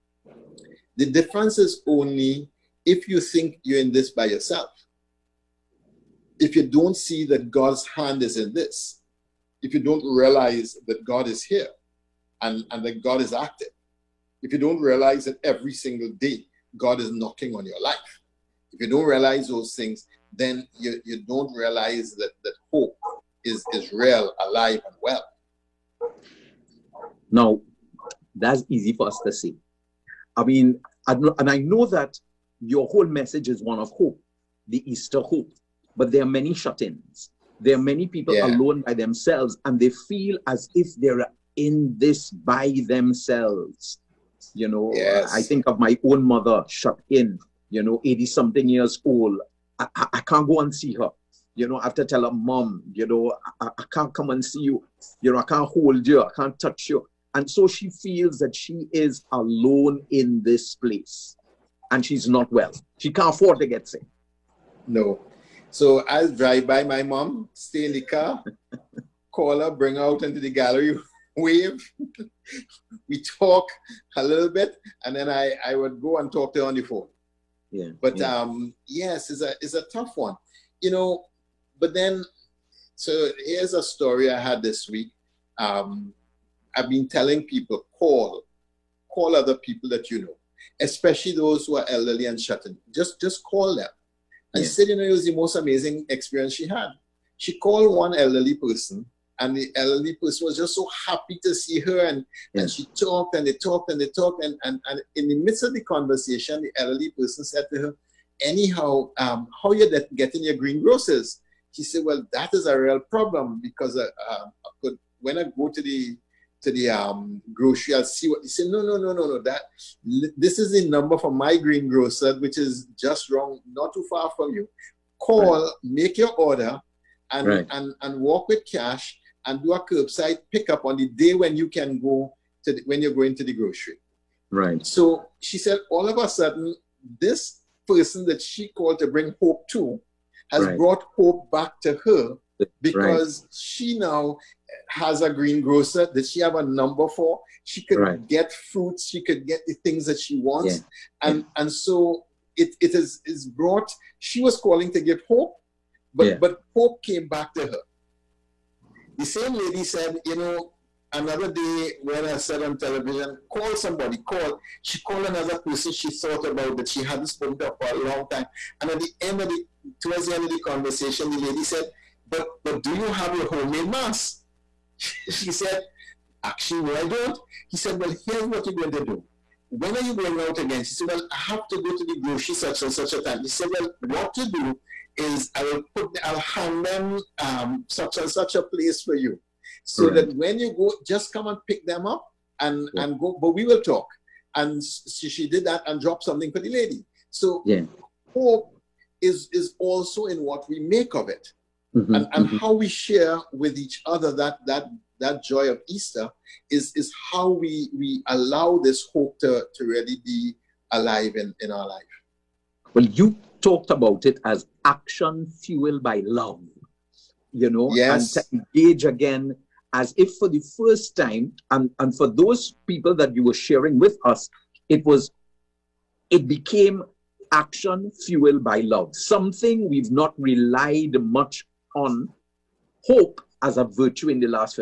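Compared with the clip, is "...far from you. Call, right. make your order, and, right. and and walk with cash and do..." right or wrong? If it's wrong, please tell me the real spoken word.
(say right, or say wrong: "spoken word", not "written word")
right.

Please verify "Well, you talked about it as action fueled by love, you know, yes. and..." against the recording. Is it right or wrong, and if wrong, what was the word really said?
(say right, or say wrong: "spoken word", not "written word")
right.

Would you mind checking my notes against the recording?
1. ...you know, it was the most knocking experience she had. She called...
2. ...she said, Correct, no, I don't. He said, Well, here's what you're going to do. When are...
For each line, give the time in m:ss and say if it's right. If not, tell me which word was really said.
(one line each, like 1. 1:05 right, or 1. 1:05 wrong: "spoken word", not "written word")
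1. 1:34 wrong: "amazing", not "knocking"
2. 2:55 wrong: "Actually", not "Correct".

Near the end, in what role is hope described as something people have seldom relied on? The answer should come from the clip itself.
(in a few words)
a virtue.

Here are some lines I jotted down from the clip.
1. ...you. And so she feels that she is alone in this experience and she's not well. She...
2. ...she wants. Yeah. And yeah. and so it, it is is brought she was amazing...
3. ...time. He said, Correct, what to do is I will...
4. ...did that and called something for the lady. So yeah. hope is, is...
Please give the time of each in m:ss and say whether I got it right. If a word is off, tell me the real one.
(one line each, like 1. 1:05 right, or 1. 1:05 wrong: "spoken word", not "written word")
1. 0:56 wrong: "place", not "experience"
2. 2:30 wrong: "calling", not "amazing"
3. 3:03 wrong: "Well", not "Correct"
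4. 3:15 wrong: "dropped", not "called".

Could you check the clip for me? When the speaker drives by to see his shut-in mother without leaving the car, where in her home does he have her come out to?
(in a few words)
gallery.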